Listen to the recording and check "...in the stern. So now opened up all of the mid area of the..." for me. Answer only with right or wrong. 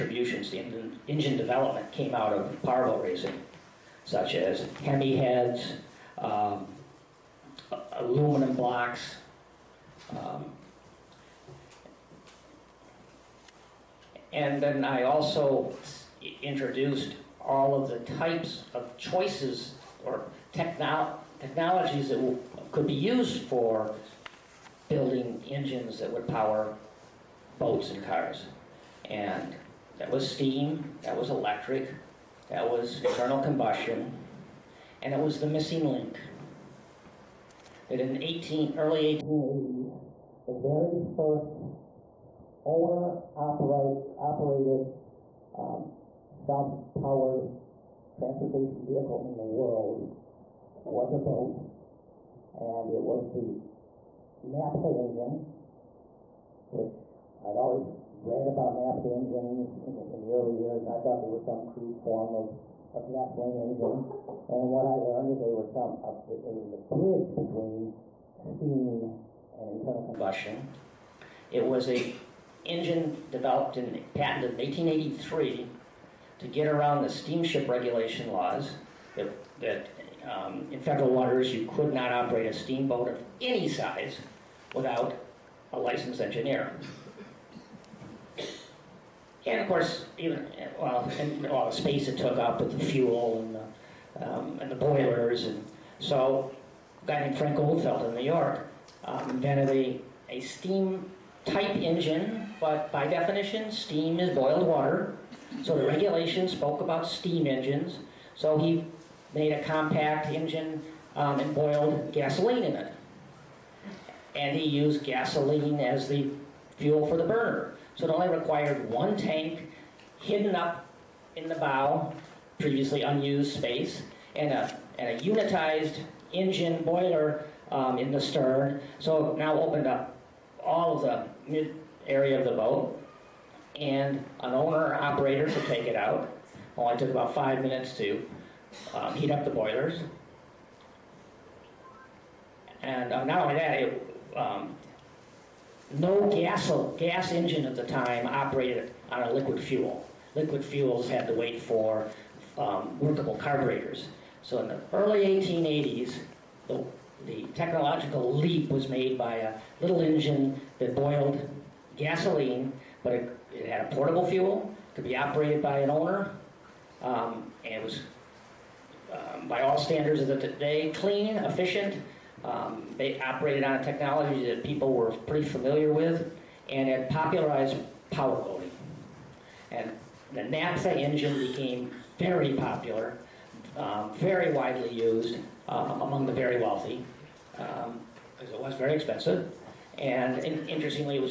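right.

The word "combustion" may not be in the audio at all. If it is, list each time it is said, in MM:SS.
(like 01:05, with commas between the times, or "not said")
00:33, 01:10.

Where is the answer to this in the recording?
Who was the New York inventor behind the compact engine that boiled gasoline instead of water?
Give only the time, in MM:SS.
01:37.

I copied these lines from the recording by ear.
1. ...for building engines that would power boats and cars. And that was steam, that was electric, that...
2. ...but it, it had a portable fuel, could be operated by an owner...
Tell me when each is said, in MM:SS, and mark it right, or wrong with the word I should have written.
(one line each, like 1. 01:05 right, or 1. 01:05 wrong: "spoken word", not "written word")
1. 00:23 right
2. 02:43 right.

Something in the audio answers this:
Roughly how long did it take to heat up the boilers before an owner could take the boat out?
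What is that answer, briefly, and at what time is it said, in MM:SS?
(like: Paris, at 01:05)
5 minutes, at 02:17.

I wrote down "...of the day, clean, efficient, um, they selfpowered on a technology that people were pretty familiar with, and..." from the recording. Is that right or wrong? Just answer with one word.
wrong.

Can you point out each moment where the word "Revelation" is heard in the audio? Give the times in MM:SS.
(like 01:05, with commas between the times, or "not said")
not said.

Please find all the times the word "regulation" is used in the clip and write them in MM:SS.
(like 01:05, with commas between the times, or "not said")
01:17, 01:45.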